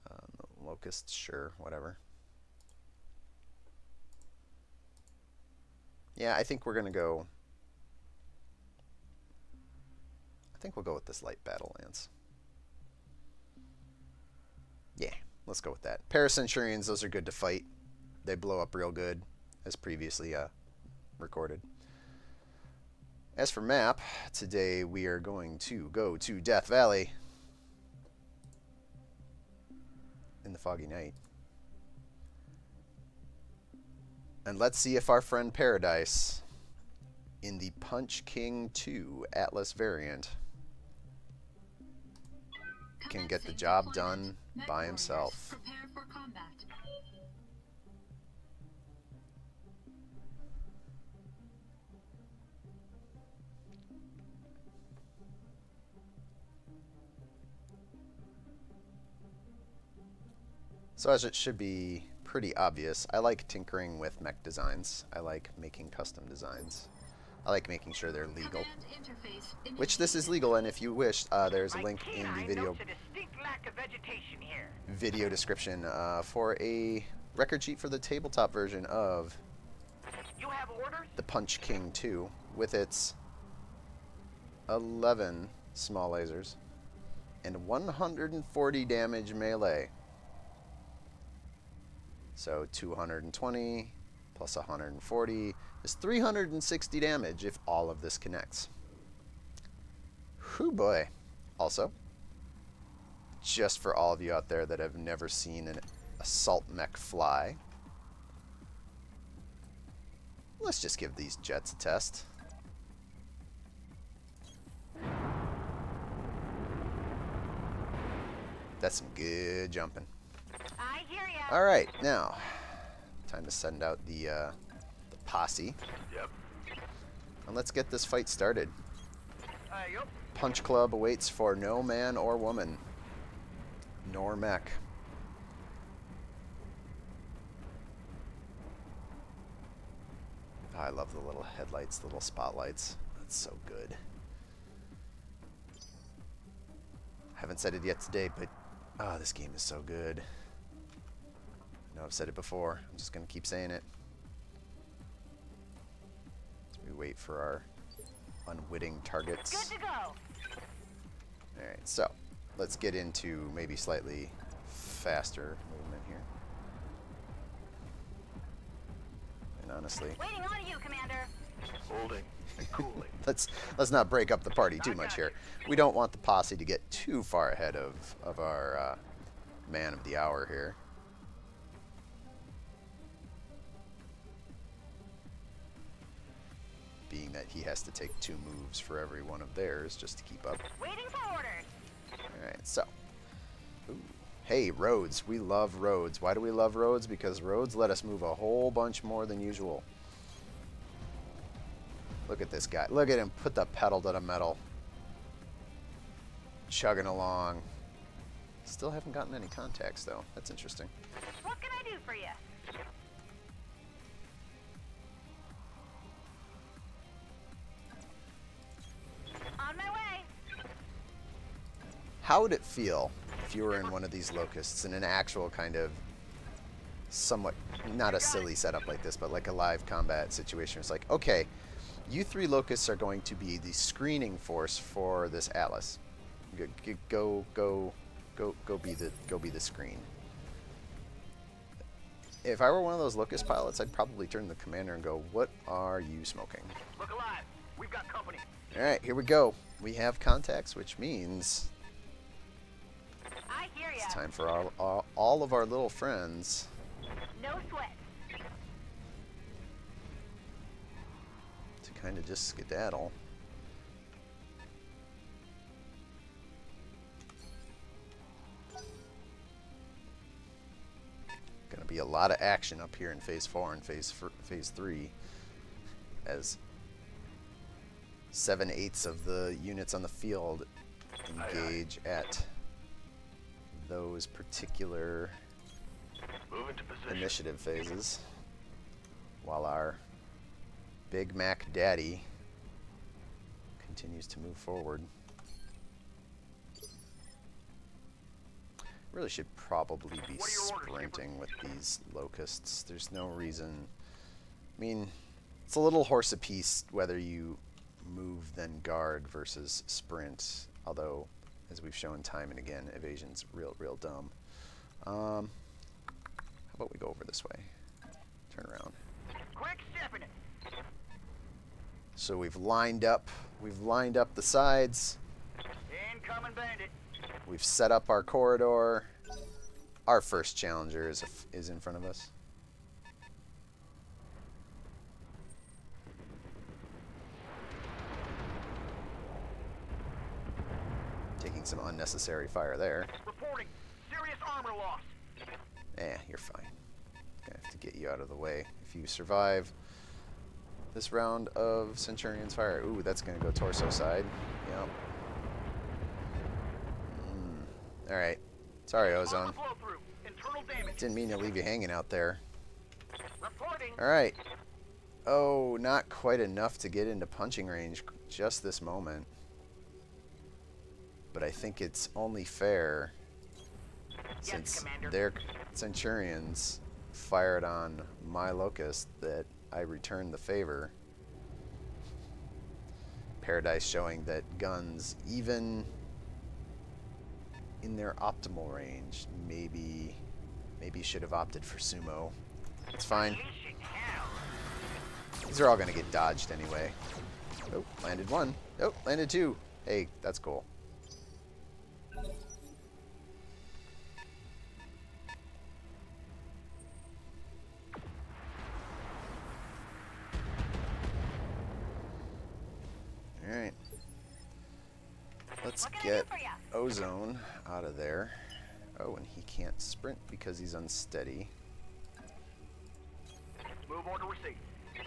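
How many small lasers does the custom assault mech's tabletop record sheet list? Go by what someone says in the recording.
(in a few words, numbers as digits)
11.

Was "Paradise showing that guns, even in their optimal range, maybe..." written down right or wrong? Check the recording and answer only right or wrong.
right.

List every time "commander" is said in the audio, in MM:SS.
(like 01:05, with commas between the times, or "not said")
02:50, 04:04.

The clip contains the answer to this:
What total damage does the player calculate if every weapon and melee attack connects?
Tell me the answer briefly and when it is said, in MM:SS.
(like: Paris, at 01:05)
360, at 01:35.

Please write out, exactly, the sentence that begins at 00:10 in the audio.
I think we'll go with this light battle lance.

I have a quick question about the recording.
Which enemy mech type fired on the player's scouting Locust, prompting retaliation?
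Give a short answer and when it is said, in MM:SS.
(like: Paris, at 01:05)
Centurions, at 06:15.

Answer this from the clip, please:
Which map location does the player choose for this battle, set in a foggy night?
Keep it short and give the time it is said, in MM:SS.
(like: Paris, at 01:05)
Death Valley, at 00:26.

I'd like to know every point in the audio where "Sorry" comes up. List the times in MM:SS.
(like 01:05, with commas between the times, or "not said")
05:58.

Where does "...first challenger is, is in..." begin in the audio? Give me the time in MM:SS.
05:30.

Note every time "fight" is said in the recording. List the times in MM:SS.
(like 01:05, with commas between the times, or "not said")
00:17, 02:08.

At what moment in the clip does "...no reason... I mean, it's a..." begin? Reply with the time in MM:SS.
05:03.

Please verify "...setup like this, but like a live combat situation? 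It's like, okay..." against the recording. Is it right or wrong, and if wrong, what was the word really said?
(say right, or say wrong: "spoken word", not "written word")
right.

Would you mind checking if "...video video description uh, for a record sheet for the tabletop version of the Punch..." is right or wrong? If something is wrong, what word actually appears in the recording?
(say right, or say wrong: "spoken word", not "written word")
right.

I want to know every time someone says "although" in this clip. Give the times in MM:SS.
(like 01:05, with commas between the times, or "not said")
05:10.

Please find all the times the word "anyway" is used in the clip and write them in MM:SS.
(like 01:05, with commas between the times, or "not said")
06:36.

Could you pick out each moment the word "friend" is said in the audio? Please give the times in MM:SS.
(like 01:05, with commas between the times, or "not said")
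00:35, 04:15.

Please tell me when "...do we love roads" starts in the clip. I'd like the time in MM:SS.
03:16.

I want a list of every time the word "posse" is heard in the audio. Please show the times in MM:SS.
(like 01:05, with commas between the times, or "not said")
02:05, 02:56.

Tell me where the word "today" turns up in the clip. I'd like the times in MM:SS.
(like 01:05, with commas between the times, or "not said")
00:24, 02:28.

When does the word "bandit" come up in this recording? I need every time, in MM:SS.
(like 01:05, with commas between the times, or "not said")
05:26.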